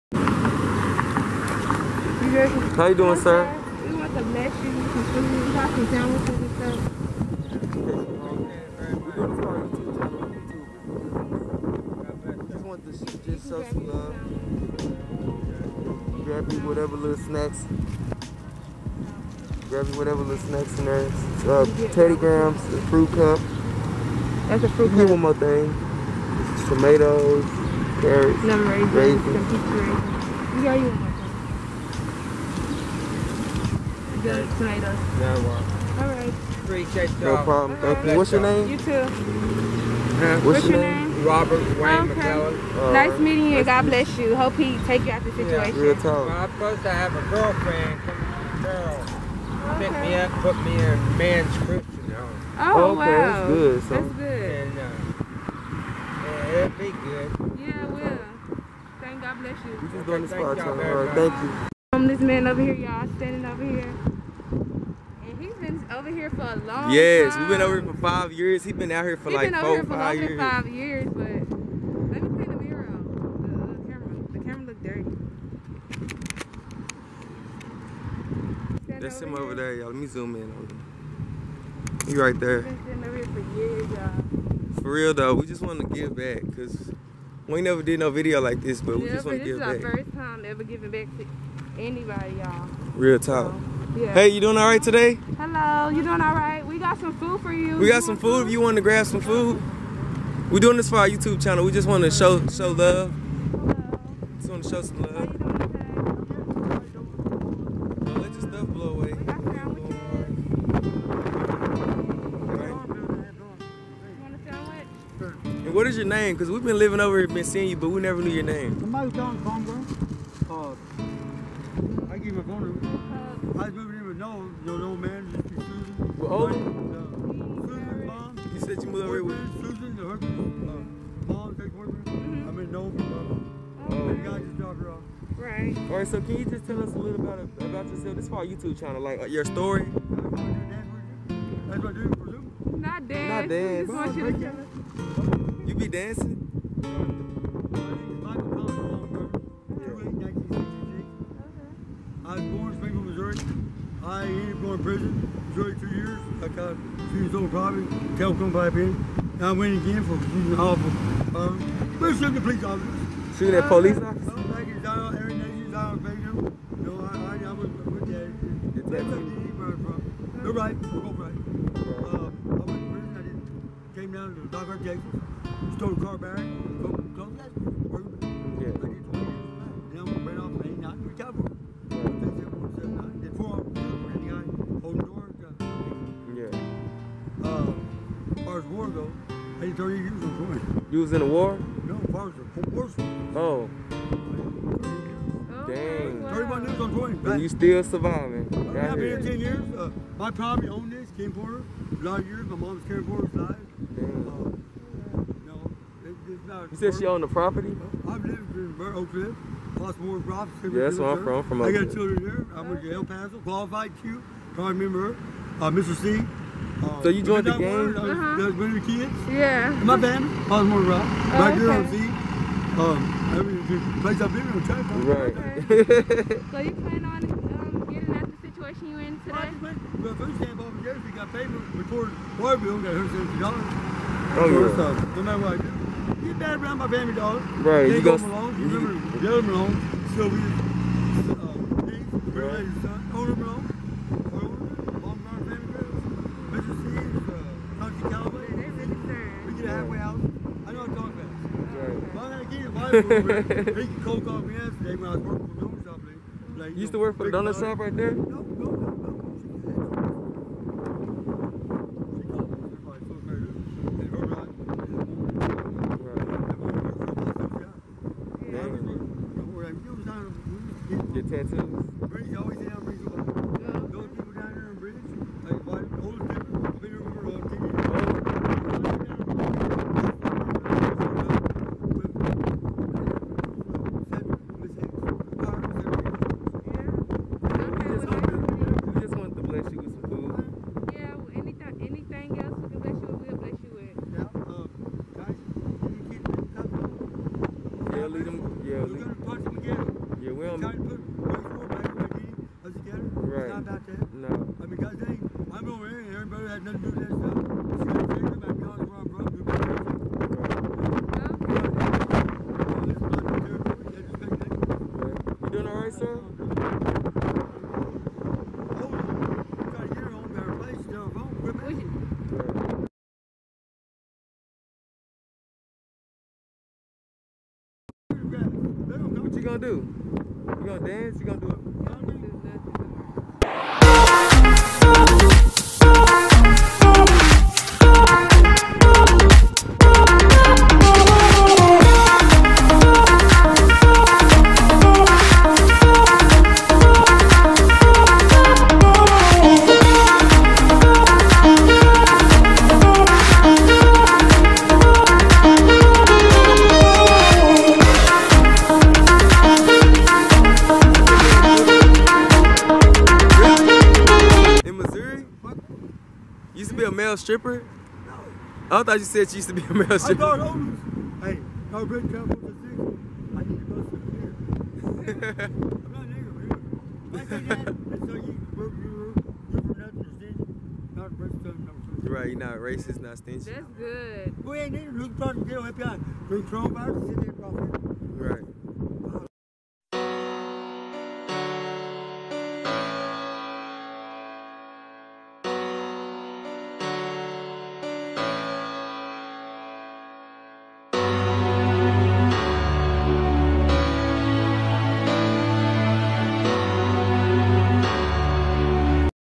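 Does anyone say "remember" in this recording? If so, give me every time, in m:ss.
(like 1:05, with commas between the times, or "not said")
3:34, 3:58.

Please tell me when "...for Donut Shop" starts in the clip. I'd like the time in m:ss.
4:15.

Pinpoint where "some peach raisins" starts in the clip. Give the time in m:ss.
0:29.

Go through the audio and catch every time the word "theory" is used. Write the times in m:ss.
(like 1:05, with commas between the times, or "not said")
not said.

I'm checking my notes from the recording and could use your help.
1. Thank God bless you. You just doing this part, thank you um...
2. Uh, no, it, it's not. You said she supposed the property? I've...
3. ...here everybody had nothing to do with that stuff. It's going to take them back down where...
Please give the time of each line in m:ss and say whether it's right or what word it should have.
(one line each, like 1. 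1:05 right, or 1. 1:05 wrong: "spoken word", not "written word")
1. 0:59 right
2. 3:24 wrong: "owned", not "supposed"
3. 5:05 right.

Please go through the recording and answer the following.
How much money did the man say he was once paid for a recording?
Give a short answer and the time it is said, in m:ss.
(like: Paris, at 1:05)
$150, at 3:52.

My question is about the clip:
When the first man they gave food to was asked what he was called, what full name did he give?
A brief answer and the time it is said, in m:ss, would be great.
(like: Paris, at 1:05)
Robert Wayne, at 0:41.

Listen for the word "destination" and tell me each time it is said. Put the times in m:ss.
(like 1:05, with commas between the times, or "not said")
not said.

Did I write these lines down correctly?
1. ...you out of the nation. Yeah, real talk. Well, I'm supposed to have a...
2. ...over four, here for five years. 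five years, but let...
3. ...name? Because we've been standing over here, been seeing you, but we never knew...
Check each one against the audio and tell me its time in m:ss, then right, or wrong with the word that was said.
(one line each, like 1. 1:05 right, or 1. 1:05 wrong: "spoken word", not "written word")
1. 0:45 wrong: "situation", not "nation"
2. 1:09 right
3. 1:56 wrong: "living", not "standing".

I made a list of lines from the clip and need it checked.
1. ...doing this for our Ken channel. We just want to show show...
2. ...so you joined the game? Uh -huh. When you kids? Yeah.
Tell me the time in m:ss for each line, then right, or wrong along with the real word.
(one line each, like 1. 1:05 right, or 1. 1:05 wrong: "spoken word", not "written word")
1. 1:40 wrong: "YouTube", not "Ken"
2. 3:37 right.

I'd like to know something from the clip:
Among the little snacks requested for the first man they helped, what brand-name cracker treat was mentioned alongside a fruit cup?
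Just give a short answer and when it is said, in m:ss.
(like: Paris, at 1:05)
Teddy Grahams, at 0:21.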